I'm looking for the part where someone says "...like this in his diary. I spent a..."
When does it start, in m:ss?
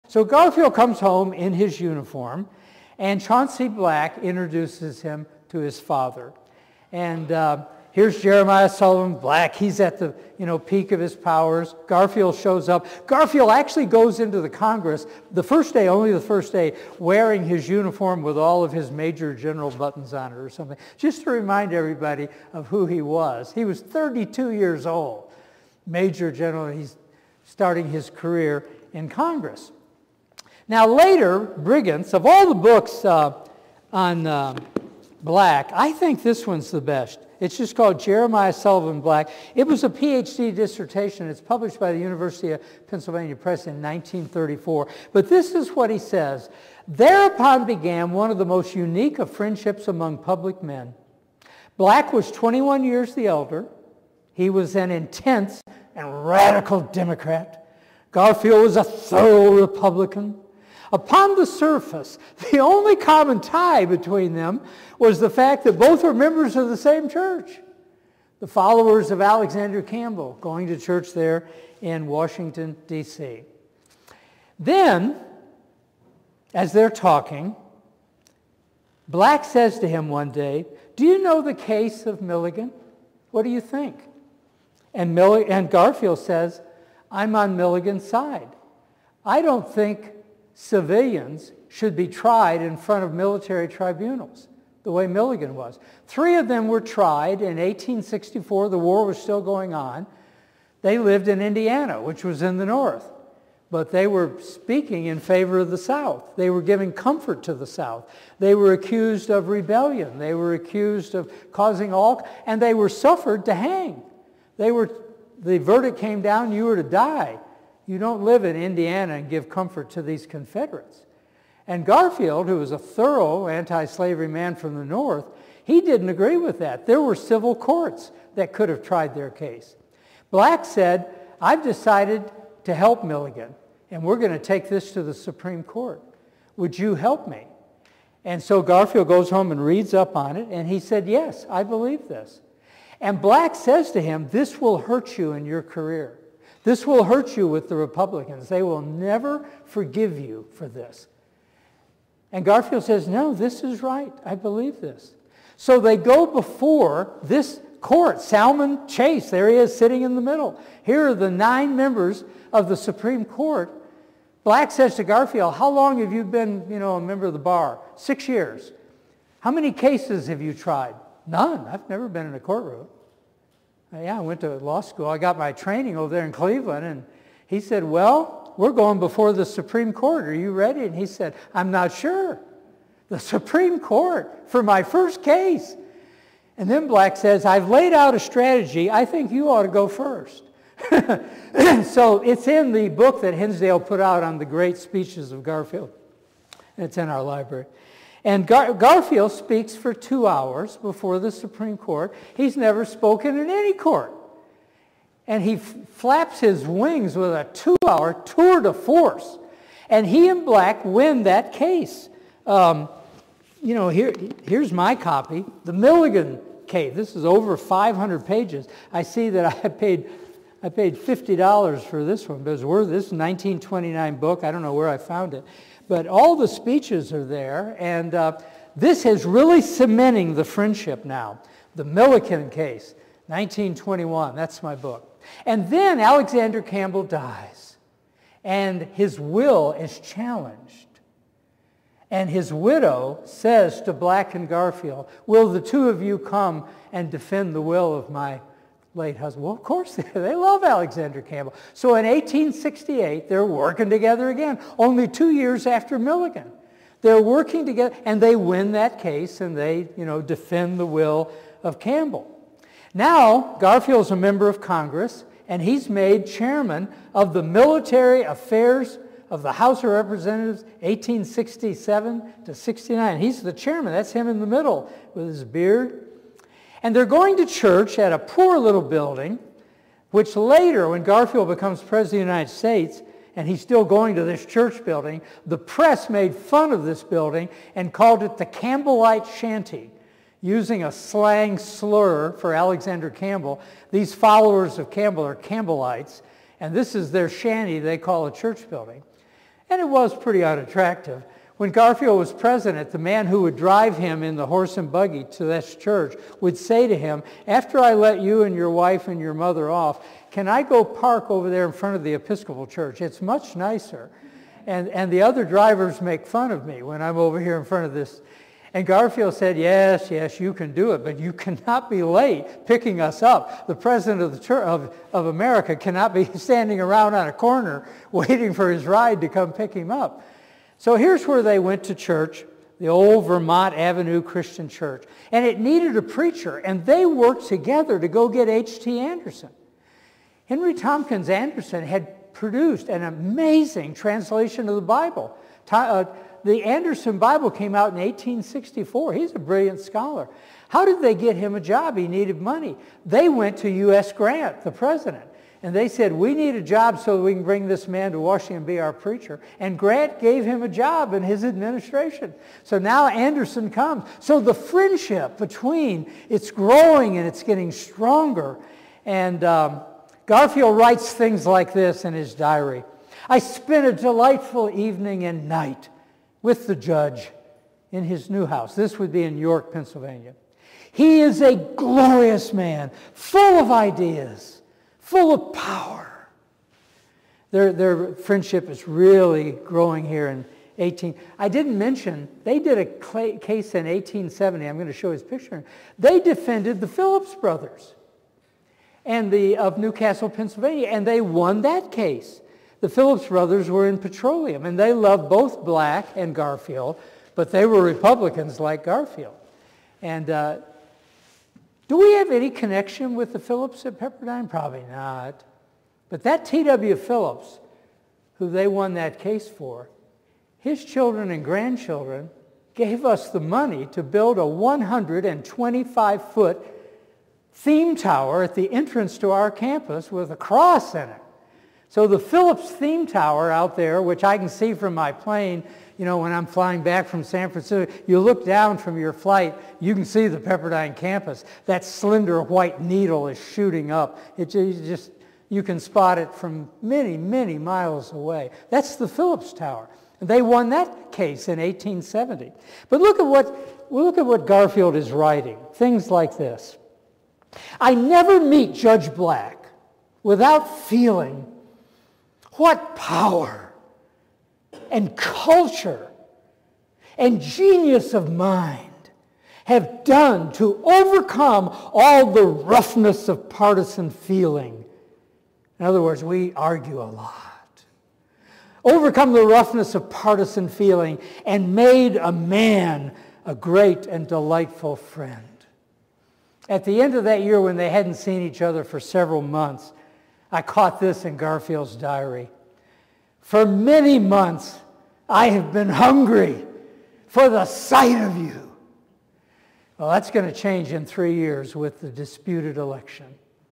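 6:11.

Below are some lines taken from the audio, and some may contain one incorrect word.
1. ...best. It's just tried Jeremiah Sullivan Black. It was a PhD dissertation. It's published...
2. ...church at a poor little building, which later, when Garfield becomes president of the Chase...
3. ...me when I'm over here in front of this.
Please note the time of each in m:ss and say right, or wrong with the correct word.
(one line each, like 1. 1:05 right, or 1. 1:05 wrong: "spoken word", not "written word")
1. 0:36 wrong: "called", not "tried"
2. 4:37 wrong: "United", not "Chase"
3. 5:16 right.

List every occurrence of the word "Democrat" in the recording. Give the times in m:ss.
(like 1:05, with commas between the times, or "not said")
0:56.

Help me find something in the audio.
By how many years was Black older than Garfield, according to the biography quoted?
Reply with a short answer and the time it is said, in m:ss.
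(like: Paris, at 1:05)
21, at 0:52.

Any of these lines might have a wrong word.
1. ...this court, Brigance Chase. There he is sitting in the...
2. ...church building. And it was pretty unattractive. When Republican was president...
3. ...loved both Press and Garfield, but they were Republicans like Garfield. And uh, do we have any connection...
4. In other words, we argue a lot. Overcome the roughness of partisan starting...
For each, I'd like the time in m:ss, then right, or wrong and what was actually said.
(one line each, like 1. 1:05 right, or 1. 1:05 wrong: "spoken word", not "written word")
1. 2:37 wrong: "Salmon", not "Brigance"
2. 4:58 wrong: "Garfield", not "Republican"
3. 6:44 wrong: "Black", not "Press"
4. 7:55 wrong: "feeling", not "starting".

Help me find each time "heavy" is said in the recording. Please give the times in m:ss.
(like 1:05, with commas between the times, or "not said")
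not said.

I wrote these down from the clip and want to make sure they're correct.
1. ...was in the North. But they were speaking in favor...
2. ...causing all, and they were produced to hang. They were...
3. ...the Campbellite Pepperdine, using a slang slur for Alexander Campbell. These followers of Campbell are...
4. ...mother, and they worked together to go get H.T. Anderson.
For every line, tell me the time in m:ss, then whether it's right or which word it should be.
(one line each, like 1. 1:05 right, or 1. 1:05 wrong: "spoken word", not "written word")
1. 1:42 right
2. 1:51 wrong: "suffered", not "produced"
3. 4:48 wrong: "Shanty", not "Pepperdine"
4. 5:36 wrong: "preacher", not "mother".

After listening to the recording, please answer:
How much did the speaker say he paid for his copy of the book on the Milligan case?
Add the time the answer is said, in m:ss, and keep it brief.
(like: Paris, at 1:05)
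$50, at 3:40.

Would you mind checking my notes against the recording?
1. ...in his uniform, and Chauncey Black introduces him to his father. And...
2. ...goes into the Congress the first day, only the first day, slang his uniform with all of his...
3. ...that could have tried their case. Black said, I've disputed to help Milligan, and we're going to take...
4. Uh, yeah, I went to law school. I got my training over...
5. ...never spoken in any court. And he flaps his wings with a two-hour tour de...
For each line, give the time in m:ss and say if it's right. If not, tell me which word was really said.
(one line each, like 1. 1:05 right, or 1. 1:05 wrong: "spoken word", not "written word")
1. 0:01 right
2. 0:13 wrong: "wearing", not "slang"
3. 2:08 wrong: "decided", not "disputed"
4. 2:53 right
5. 3:22 right.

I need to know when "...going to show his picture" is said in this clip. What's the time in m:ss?
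6:34.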